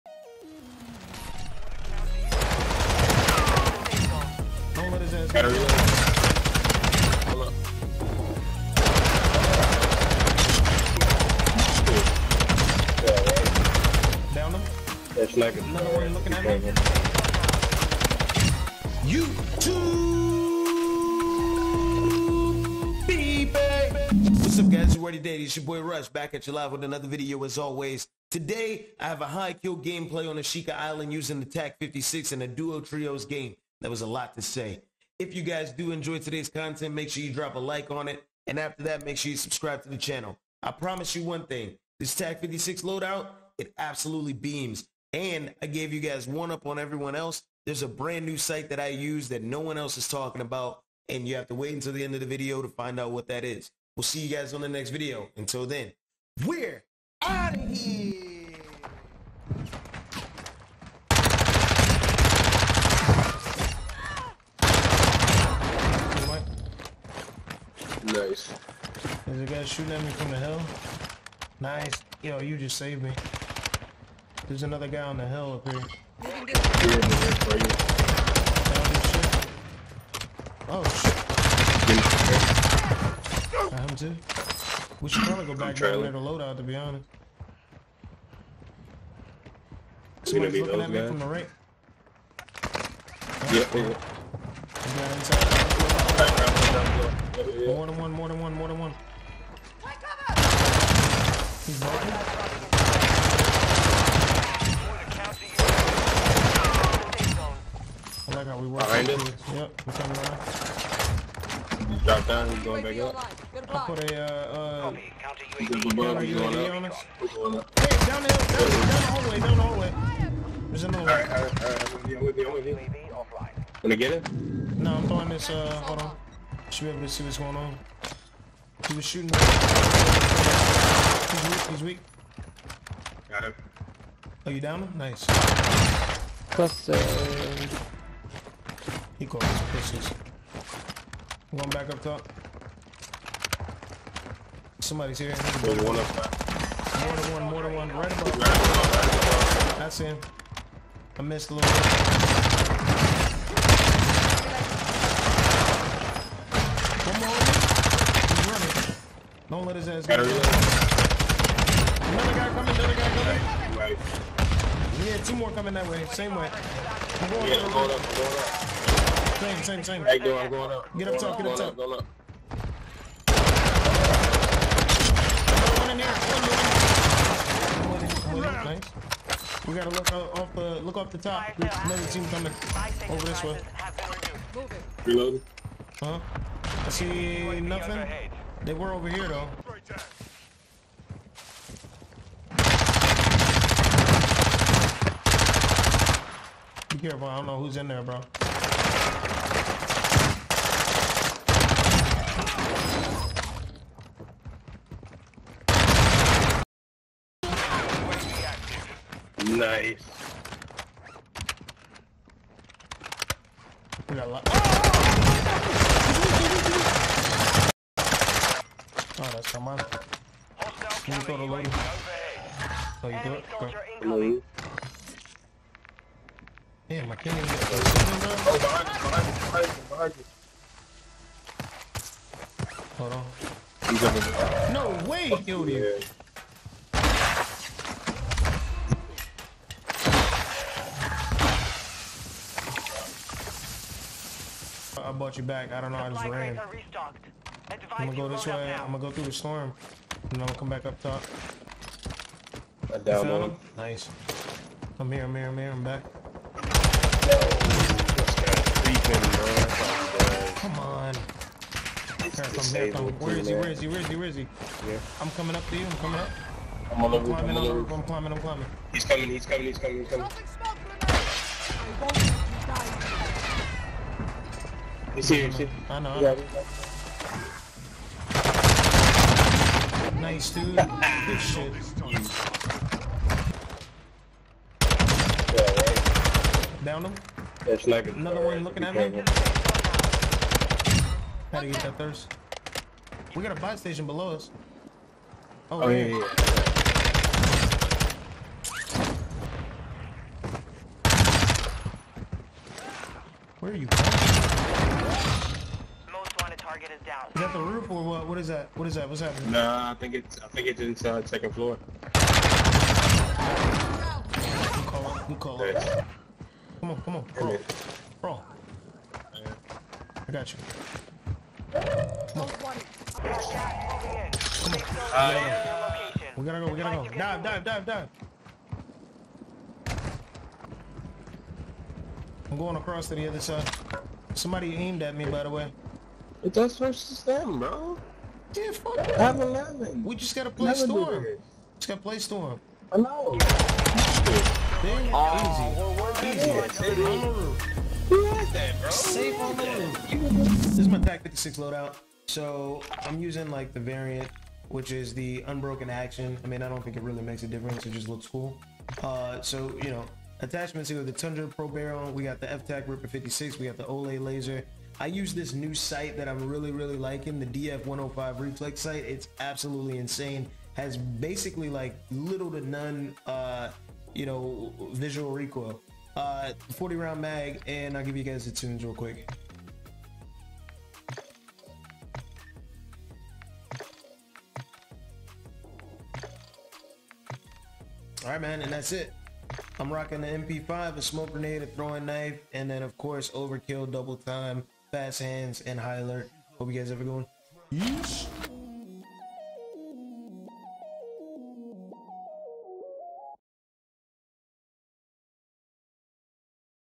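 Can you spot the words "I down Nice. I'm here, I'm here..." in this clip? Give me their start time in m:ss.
4:12.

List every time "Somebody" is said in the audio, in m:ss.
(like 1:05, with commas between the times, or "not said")
1:30, 2:24, 5:34.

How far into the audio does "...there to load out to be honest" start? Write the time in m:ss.
1:26.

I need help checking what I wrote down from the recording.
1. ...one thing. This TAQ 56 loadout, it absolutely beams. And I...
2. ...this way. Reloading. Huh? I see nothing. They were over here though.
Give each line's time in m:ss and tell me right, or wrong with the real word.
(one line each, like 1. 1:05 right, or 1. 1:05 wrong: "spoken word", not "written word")
1. 0:41 right
2. 3:03 right.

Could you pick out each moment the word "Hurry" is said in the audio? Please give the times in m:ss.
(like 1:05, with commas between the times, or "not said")
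0:05.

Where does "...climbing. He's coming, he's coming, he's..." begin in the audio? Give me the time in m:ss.
4:28.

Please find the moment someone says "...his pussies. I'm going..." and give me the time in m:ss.
2:19.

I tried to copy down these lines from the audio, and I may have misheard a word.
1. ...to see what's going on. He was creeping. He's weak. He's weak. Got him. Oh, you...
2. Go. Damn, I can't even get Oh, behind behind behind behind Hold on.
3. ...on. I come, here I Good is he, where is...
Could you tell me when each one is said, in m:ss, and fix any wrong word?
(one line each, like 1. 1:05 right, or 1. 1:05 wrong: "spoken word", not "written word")
1. 2:07 wrong: "shooting", not "creeping"
2. 3:44 right
3. 4:20 wrong: "Where", not "Good".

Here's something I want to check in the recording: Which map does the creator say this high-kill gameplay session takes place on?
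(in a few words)
Ashika Island.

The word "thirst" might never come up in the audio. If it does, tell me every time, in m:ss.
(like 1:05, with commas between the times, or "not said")
4:51.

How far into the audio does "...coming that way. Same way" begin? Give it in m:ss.
2:45.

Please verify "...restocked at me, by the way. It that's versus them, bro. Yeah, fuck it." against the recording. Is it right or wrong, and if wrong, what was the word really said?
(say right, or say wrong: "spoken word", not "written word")
wrong: "aimed", not "restocked".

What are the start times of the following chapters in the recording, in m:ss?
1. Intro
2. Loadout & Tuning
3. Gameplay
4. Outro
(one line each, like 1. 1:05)
1. 0:19
2. 5:50
3. 0:58
4. 6:38.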